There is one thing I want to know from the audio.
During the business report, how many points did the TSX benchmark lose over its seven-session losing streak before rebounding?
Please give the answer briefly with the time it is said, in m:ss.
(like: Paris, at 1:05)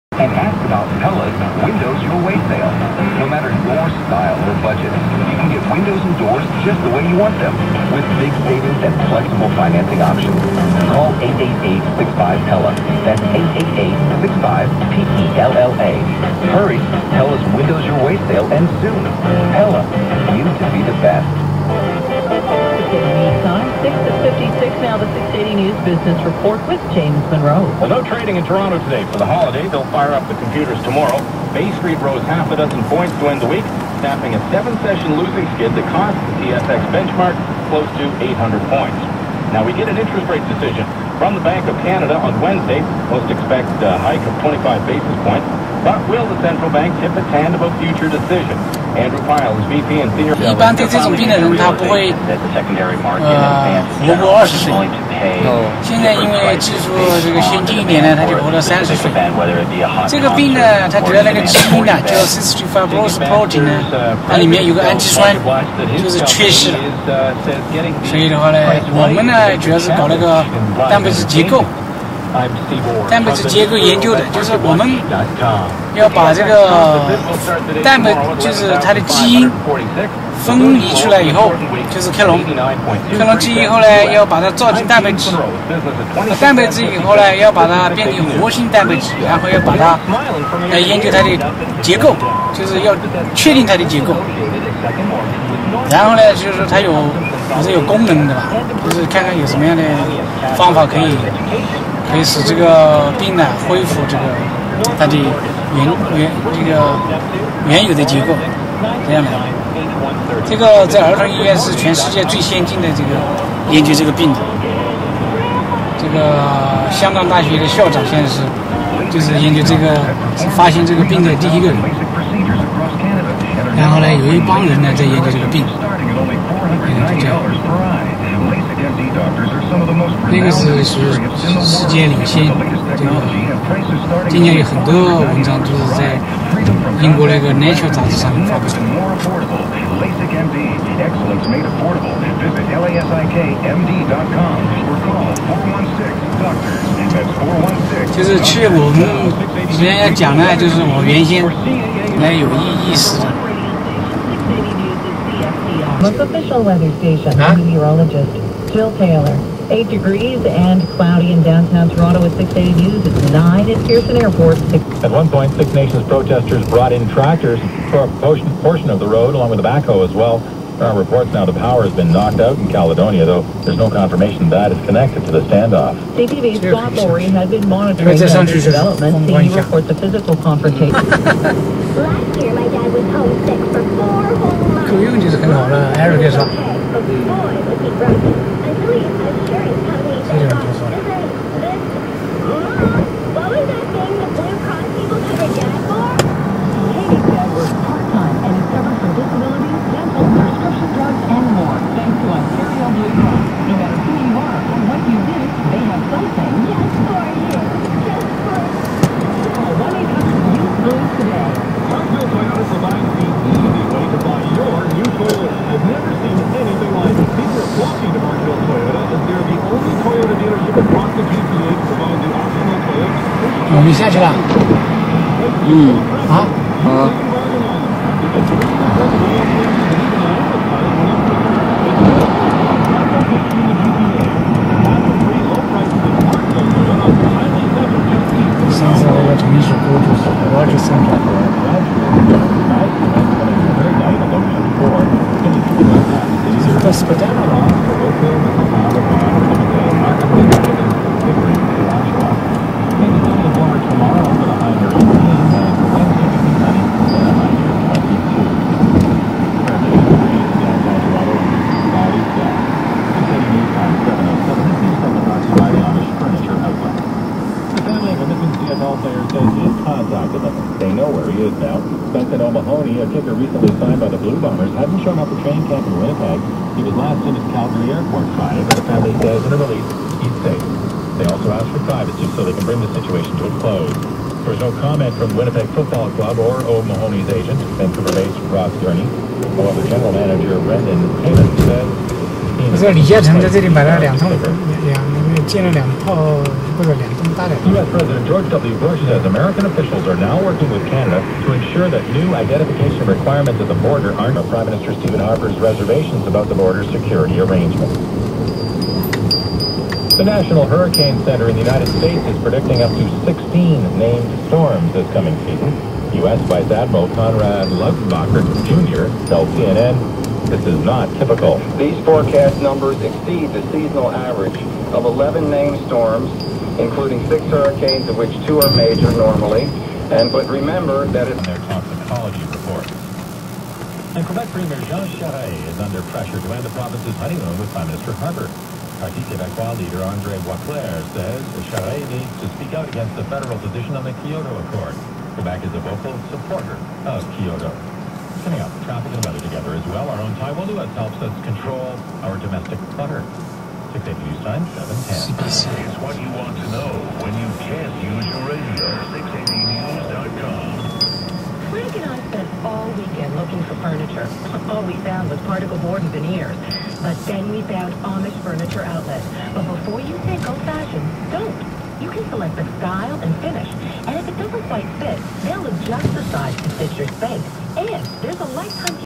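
close to 800, at 0:37.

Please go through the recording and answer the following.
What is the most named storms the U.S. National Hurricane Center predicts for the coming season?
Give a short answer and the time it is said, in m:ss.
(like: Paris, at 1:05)
16, at 5:13.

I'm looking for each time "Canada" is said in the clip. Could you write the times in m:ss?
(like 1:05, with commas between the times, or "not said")
0:41, 5:00.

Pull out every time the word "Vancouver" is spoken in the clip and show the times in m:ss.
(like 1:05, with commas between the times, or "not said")
4:47.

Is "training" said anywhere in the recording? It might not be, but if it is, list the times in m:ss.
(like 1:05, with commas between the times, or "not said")
4:35.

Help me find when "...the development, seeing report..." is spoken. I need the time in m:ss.
2:58.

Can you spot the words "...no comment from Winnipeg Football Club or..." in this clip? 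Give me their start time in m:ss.
4:44.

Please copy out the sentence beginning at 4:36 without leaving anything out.
He was last seen at Calgary Airport Friday, but the family says in a release he's safe.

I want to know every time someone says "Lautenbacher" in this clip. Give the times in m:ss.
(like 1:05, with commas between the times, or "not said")
5:17.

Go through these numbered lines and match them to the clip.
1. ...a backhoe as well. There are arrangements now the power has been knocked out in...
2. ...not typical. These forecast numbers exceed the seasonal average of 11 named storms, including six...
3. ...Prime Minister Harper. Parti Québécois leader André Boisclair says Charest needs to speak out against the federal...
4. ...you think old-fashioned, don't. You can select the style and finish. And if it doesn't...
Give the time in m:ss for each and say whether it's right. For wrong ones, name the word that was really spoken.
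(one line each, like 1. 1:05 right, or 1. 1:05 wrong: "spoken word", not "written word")
1. 2:49 wrong: "reports", not "arrangements"
2. 5:20 right
3. 5:37 right
4. 6:10 right.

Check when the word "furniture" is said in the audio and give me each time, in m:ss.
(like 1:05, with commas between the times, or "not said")
6:03, 6:08.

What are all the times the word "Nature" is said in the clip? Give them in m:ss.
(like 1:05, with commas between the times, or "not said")
2:17.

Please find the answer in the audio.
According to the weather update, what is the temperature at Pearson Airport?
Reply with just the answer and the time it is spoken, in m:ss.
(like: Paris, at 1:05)
9, at 2:43.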